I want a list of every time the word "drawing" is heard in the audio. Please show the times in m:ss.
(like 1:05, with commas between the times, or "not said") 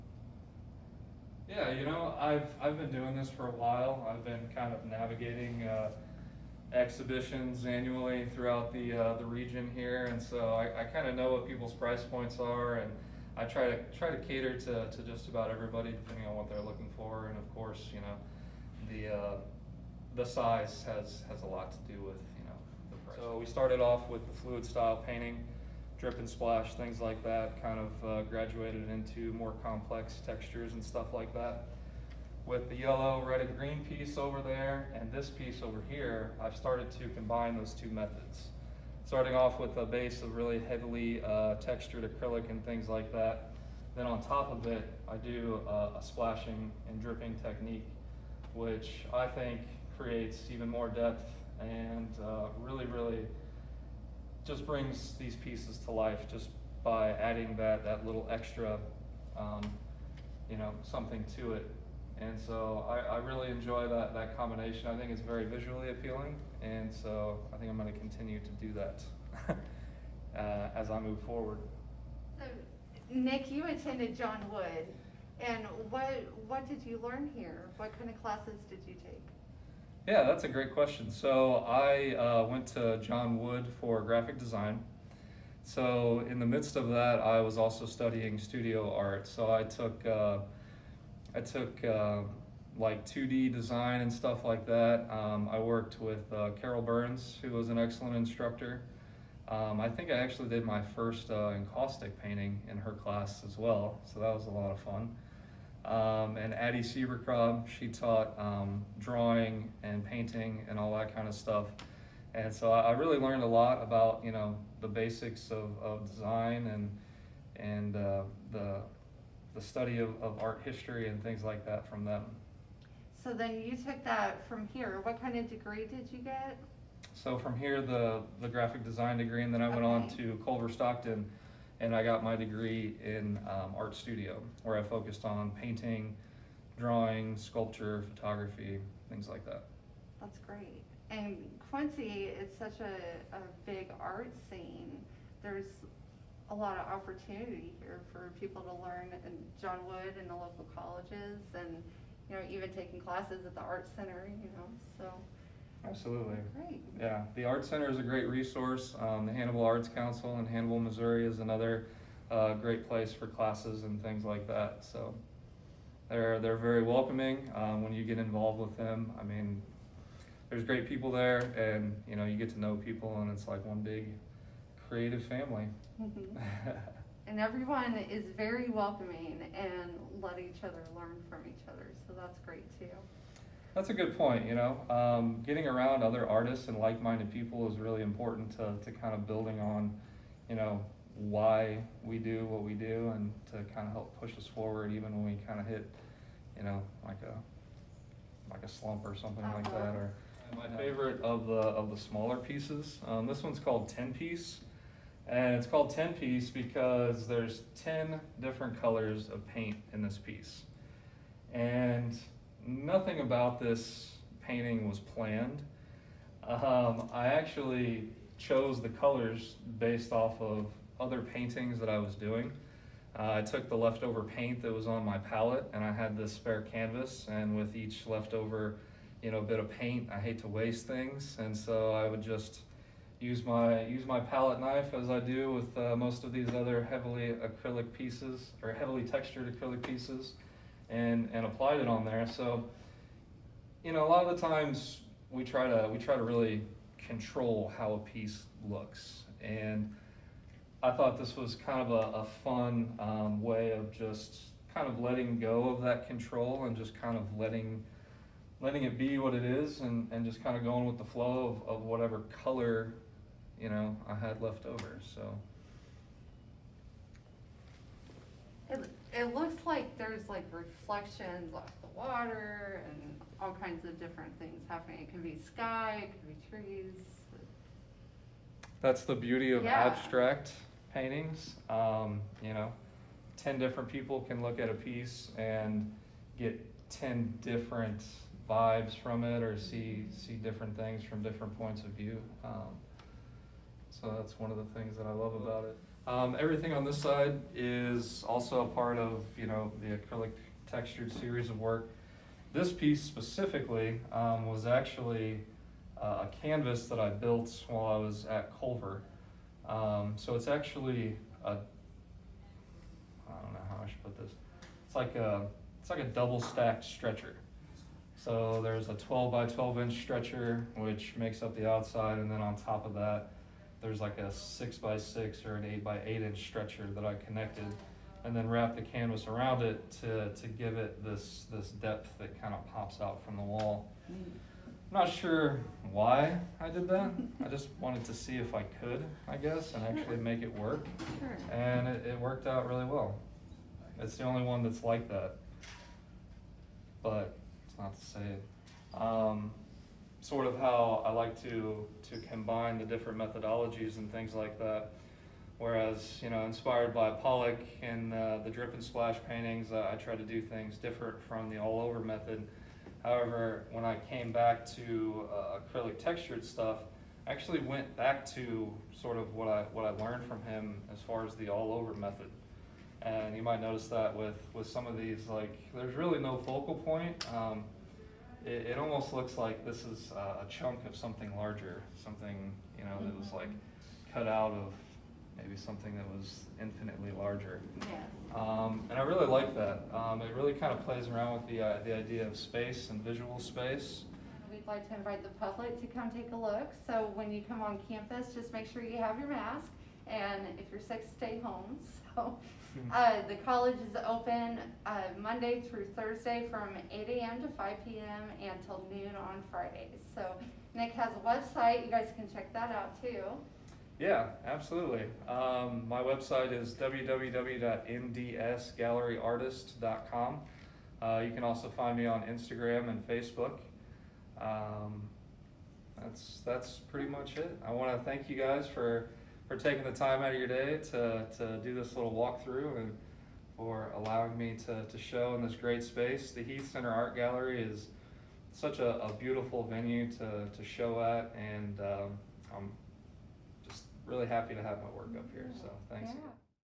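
1:48, 2:16.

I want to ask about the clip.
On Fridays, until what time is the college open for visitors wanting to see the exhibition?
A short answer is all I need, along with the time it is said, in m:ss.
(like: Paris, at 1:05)
noon, at 6:48.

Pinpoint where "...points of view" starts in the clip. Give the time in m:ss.
4:51.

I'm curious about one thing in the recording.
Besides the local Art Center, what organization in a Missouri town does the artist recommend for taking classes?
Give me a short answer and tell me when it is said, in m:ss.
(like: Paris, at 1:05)
Hannibal Arts Council, at 2:39.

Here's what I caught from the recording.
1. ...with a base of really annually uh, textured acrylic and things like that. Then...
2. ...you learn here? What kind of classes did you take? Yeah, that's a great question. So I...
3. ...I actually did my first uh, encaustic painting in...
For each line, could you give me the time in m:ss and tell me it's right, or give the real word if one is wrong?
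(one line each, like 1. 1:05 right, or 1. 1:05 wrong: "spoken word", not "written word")
1. 0:39 wrong: "heavily", not "annually"
2. 1:16 right
3. 1:40 right.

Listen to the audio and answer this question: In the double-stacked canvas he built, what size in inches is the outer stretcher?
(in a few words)
12 by 12 inches.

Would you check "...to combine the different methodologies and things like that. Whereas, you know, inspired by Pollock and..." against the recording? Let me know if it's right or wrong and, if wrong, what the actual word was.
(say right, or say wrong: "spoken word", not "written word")
right.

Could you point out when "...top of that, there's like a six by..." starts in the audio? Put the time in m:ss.
5:22.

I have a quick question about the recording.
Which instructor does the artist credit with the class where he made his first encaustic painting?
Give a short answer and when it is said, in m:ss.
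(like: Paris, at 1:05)
Carol Burns, at 1:36.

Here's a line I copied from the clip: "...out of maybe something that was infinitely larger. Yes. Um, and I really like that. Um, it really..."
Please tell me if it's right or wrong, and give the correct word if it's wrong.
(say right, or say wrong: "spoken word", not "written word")
right.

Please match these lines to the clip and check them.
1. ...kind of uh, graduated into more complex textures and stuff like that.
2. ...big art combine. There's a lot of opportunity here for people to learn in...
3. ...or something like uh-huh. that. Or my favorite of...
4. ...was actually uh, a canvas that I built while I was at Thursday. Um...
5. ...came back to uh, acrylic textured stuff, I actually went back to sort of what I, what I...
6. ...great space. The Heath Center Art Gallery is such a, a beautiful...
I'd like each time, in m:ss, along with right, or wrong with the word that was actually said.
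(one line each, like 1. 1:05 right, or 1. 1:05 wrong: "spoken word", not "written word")
1. 0:27 right
2. 2:23 wrong: "scene", not "combine"
3. 3:19 right
4. 5:04 wrong: "Culver", not "Thursday"
5. 6:04 right
6. 7:15 right.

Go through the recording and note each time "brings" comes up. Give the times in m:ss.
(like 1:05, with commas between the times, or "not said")
0:54.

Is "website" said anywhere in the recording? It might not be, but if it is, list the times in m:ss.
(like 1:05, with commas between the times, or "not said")
6:51, 6:56.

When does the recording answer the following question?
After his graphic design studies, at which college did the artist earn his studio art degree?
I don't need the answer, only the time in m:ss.
2:10.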